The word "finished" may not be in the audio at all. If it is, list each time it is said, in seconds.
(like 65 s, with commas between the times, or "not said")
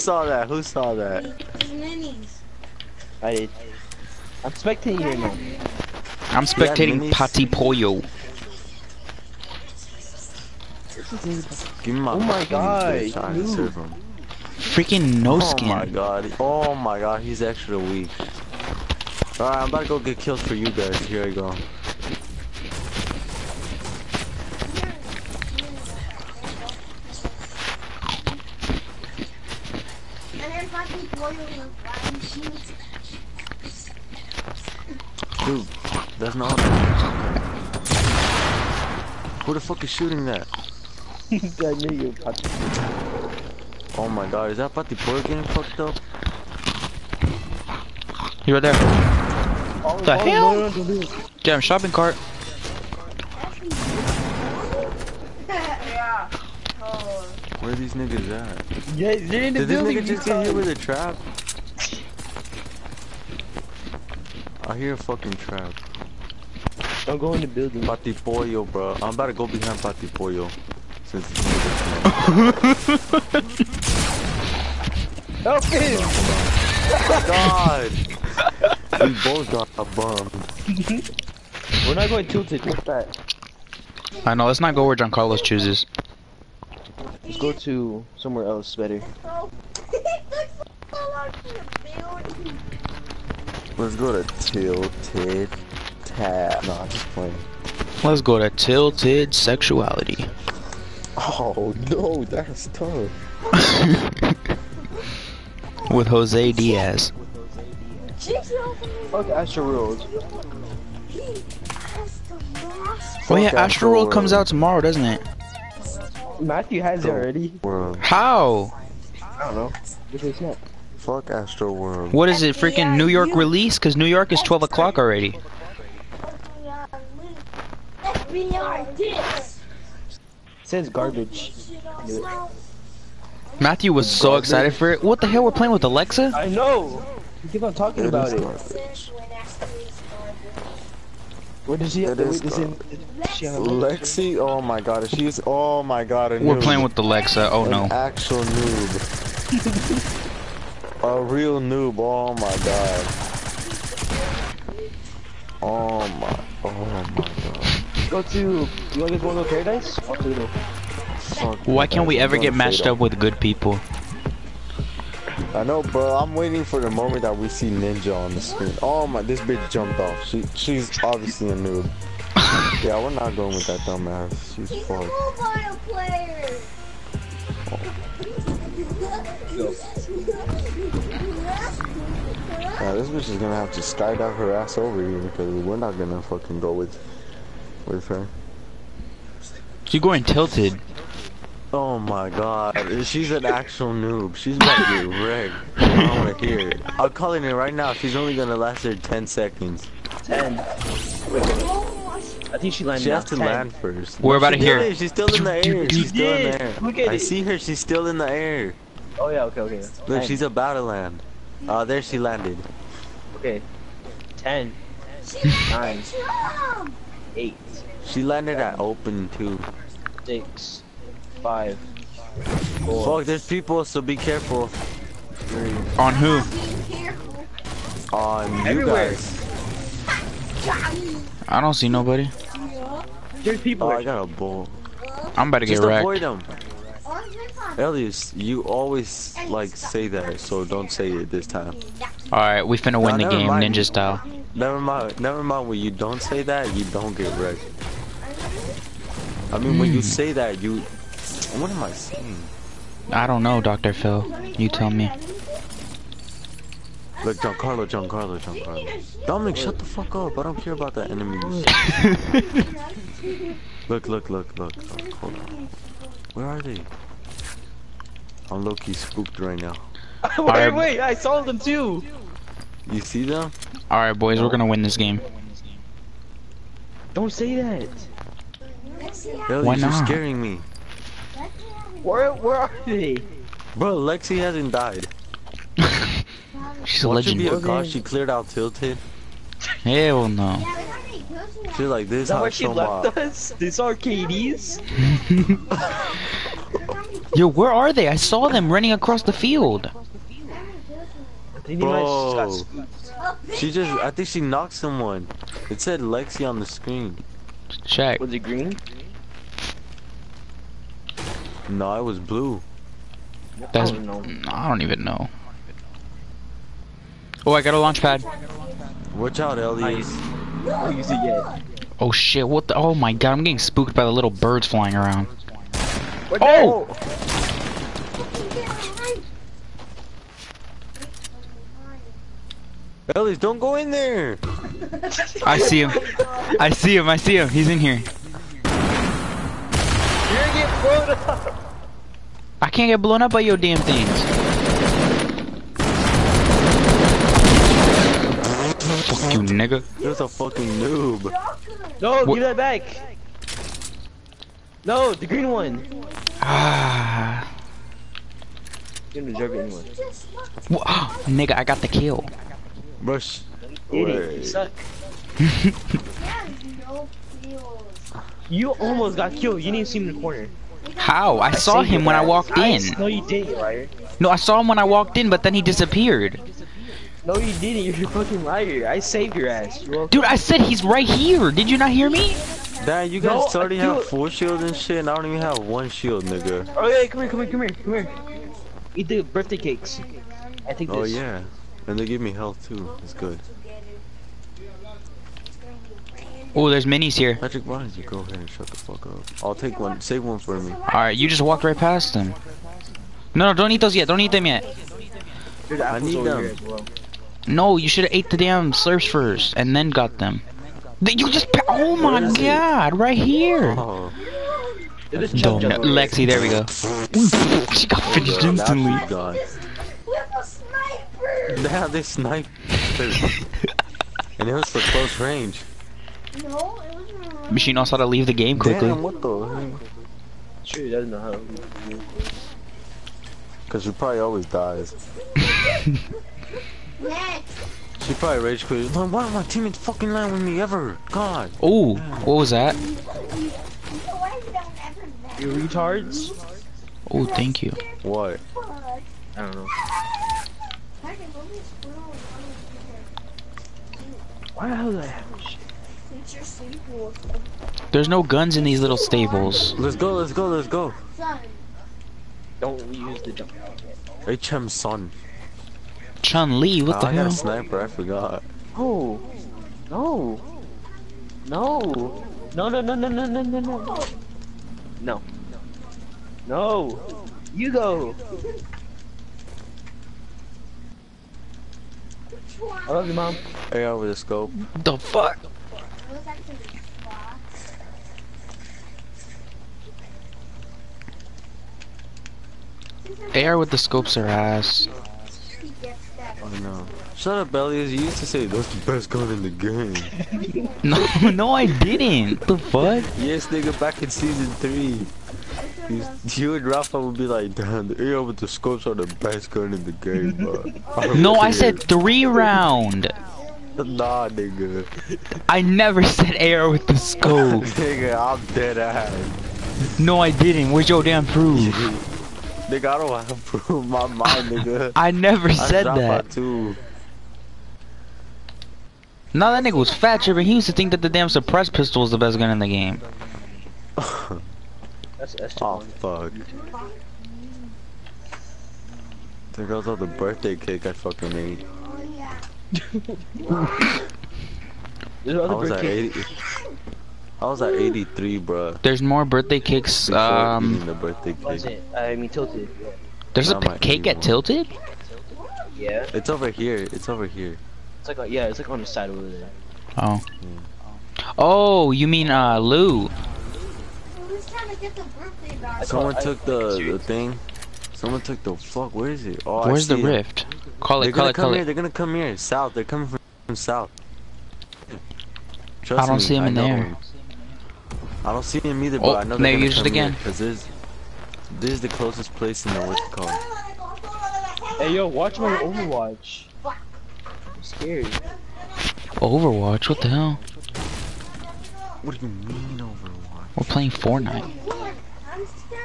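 418 s.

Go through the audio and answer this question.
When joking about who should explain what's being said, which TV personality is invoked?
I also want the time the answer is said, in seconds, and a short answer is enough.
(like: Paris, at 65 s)
Dr. Phil, at 253 s.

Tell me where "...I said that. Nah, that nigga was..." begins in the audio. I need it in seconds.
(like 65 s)
525 s.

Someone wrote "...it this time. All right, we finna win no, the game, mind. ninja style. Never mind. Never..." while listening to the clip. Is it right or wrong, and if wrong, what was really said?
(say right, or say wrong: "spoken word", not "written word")
right.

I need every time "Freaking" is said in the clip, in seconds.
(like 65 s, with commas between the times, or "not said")
14 s, 122 s.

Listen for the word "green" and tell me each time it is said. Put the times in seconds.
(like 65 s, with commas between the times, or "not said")
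308 s, 355 s.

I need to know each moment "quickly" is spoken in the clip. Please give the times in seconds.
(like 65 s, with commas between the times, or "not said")
428 s.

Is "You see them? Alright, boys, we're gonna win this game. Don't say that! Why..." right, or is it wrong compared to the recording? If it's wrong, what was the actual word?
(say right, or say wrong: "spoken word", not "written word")
right.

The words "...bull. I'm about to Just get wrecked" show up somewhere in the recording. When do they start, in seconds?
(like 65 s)
234 s.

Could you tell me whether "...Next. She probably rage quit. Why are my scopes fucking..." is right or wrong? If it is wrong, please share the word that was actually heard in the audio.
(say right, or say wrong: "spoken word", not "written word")
wrong: "teammates", not "scopes".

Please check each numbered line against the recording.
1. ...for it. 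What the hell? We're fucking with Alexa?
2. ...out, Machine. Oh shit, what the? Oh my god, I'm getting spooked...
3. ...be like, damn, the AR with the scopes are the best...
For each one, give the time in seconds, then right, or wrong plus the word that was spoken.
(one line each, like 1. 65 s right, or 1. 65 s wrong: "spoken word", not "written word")
1. 134 s wrong: "playing", not "fucking"
2. 319 s wrong: "Elliot", not "Machine"
3. 507 s right.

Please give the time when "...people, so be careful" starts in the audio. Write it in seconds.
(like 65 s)
223 s.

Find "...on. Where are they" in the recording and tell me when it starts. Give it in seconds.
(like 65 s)
265 s.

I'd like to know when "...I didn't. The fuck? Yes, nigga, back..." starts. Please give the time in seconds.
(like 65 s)
501 s.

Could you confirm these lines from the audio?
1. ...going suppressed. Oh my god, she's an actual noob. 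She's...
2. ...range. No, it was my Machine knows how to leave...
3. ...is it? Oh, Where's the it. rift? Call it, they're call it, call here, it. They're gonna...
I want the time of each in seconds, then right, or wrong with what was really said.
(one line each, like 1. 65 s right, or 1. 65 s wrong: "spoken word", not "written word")
1. 190 s wrong: "tilted", not "suppressed"
2. 425 s right
3. 569 s right.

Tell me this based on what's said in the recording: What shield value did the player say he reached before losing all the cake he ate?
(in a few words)
83.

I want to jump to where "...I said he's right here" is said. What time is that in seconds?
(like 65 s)
380 s.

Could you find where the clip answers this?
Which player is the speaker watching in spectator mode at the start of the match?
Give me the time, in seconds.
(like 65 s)
7 s.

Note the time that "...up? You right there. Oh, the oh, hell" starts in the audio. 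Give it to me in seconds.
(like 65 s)
45 s.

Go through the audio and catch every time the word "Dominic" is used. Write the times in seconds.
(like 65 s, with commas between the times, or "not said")
259 s.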